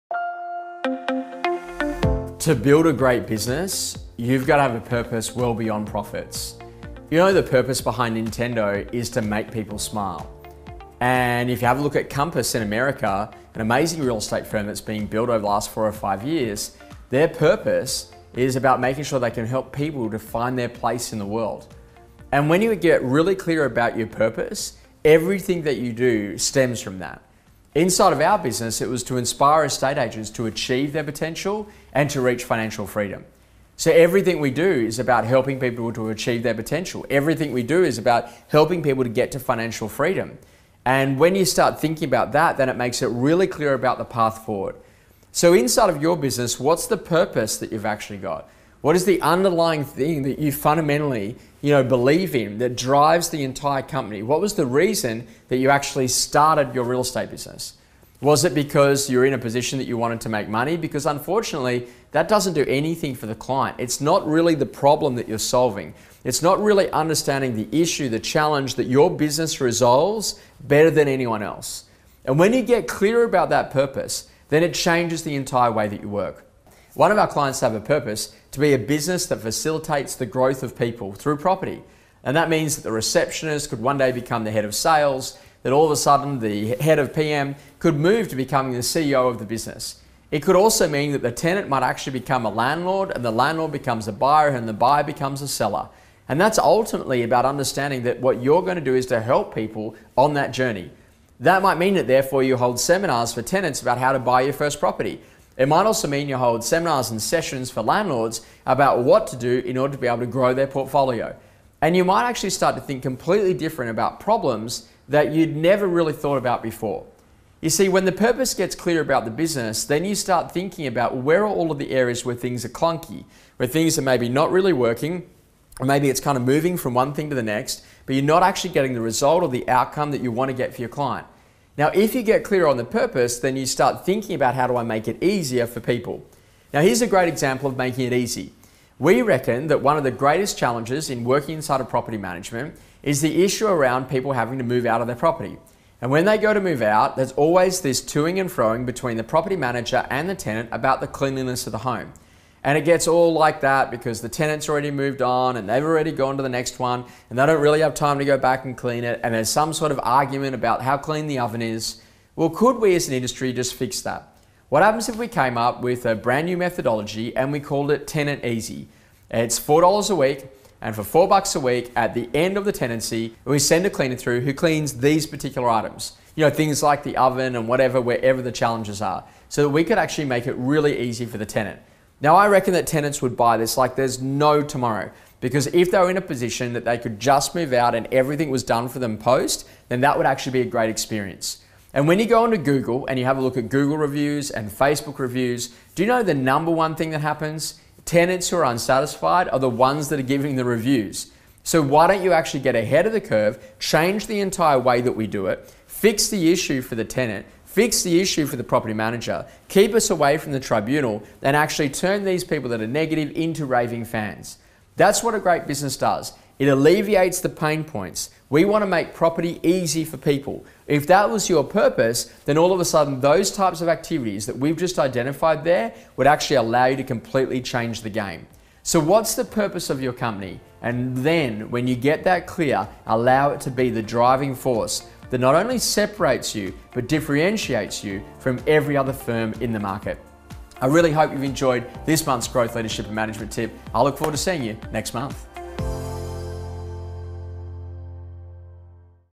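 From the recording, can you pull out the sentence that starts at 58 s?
Was it because you're in a position that you wanted to make money?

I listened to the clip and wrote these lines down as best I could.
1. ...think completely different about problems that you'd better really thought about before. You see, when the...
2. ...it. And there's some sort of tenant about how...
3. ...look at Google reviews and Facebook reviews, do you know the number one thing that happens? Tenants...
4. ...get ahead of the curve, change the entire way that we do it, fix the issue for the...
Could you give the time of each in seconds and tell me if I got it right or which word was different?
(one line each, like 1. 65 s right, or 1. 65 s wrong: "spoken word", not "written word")
1. 112 s wrong: "never", not "better"
2. 159 s wrong: "argument", not "tenant"
3. 193 s right
4. 202 s right.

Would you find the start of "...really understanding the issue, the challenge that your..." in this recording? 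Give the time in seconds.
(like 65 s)
66 s.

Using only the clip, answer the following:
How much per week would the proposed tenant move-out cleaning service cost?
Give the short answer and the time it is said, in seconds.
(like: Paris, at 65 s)
$4, at 169 s.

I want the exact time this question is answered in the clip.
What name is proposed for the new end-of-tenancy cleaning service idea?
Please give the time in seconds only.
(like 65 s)
168 s.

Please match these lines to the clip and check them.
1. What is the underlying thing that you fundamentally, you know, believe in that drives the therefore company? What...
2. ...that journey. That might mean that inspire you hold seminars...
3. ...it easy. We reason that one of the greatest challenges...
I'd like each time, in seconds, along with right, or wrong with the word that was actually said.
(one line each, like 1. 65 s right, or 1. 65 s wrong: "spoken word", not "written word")
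1. 48 s wrong: "entire", not "therefore"
2. 100 s wrong: "therefore", not "inspire"
3. 138 s wrong: "reckon", not "reason".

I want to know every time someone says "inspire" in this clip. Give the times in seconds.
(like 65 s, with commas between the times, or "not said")
29 s.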